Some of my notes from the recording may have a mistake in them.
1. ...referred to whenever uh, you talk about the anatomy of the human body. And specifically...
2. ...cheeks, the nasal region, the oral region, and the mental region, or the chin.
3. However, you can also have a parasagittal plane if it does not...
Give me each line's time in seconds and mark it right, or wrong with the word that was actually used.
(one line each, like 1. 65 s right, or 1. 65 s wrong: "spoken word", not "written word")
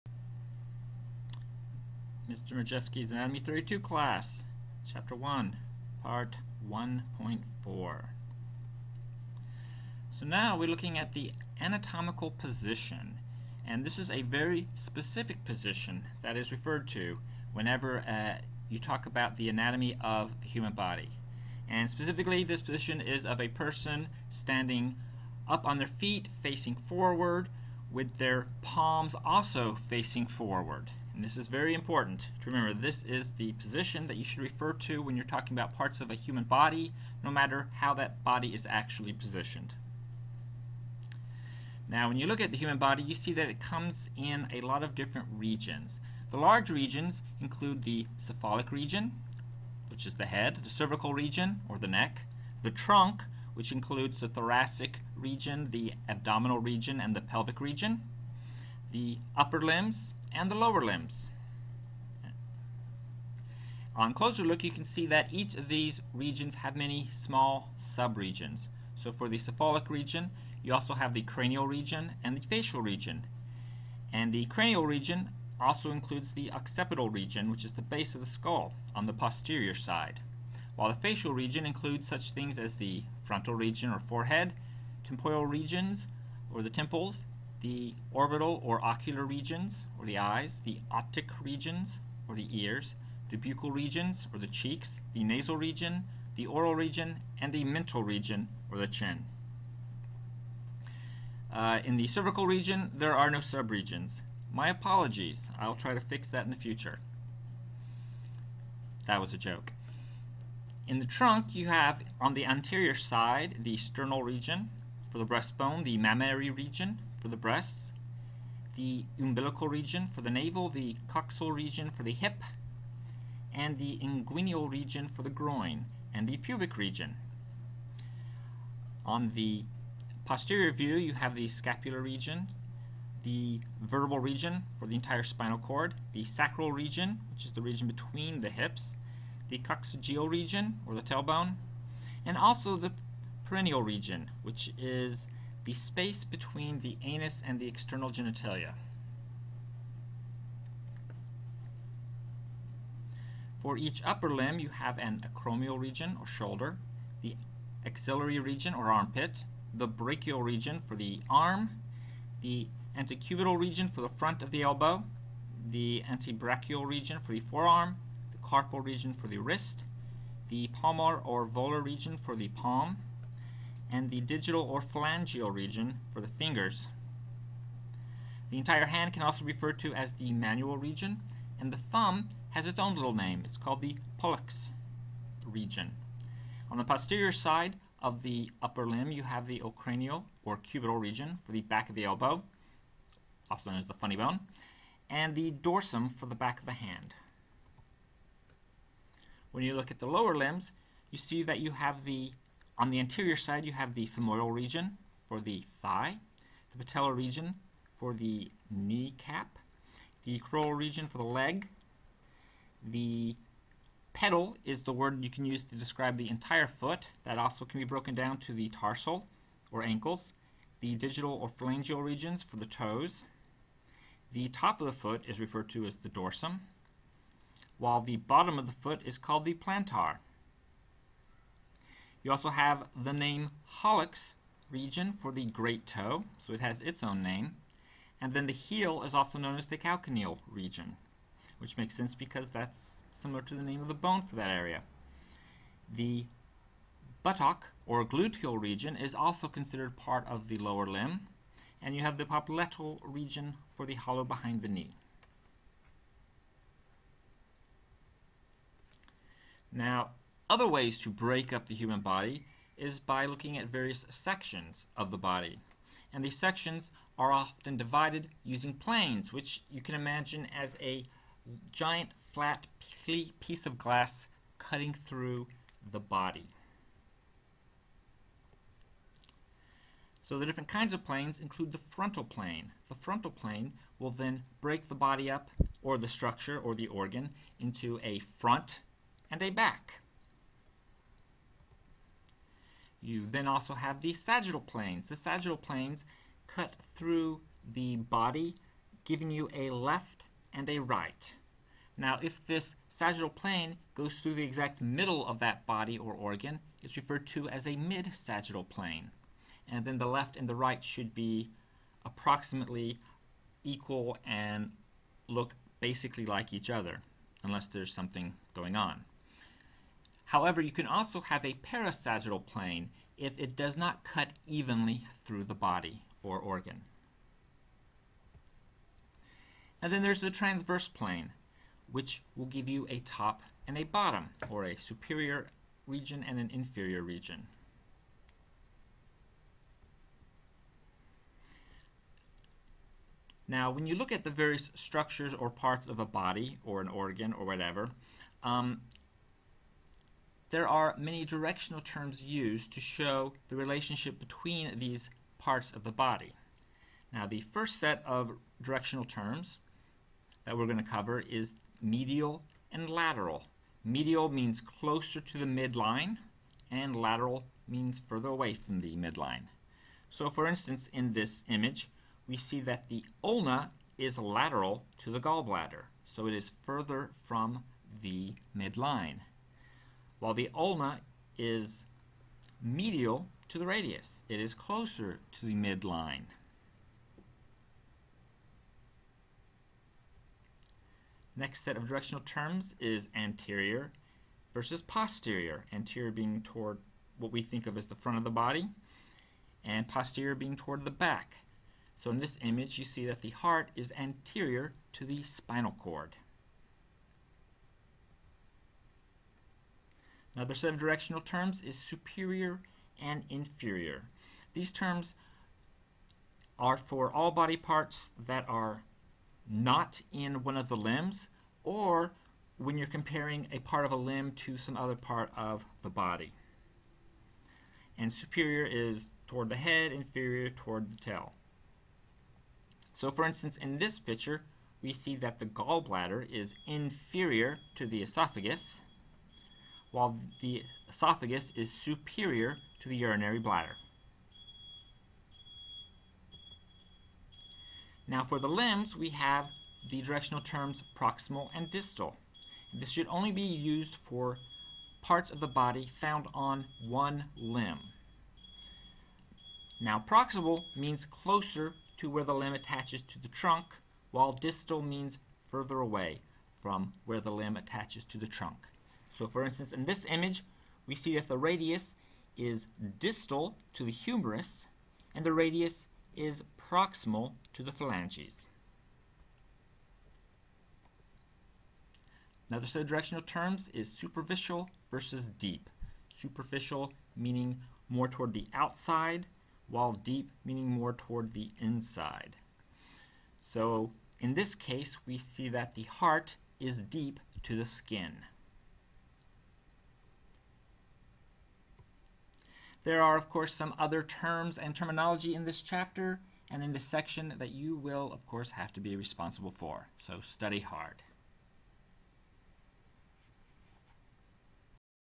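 1. 16 s right
2. 94 s right
3. 320 s right.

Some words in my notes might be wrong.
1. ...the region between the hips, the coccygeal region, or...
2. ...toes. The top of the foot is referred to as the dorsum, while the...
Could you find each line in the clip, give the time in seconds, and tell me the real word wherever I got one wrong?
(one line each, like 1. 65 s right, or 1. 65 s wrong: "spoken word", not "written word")
1. 137 s right
2. 222 s right.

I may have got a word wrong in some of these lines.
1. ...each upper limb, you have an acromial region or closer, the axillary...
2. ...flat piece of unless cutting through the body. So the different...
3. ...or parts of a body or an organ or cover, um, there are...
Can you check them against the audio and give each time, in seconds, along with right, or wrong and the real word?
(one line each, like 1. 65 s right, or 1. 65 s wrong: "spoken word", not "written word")
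1. 153 s wrong: "shoulder", not "closer"
2. 272 s wrong: "glass", not "unless"
3. 345 s wrong: "whatever", not "cover".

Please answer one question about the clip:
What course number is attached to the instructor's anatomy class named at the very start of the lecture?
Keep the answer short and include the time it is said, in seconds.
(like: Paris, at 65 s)
32, at 3 s.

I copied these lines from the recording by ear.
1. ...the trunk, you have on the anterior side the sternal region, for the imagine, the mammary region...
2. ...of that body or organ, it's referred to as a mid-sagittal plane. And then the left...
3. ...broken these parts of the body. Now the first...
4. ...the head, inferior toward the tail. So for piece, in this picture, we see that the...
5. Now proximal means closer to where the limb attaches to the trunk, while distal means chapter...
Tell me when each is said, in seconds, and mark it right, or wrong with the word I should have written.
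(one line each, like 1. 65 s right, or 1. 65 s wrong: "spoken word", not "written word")
1. 110 s wrong: "breastbone", not "imagine"
2. 305 s right
3. 354 s wrong: "between", not "broken"
4. 429 s wrong: "instance", not "piece"
5. 459 s wrong: "further", not "chapter".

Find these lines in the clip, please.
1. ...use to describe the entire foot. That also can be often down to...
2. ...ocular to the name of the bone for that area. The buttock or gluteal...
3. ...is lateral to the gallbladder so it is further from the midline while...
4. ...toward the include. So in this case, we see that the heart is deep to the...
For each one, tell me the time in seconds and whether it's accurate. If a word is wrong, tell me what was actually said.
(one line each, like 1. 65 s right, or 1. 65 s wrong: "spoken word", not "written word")
1. 215 s wrong: "broken", not "often"
2. 243 s wrong: "similar", not "ocular"
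3. 373 s right
4. 490 s wrong: "inside", not "include".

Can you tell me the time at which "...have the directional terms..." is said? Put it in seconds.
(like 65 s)
449 s.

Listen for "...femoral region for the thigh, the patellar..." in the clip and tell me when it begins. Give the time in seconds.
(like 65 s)
204 s.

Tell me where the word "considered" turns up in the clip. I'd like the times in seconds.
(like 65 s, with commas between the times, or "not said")
249 s.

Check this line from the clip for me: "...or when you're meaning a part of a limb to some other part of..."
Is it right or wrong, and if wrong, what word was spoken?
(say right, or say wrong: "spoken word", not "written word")
wrong: "comparing", not "meaning".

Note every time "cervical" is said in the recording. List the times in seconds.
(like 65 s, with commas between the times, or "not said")
50 s, 102 s.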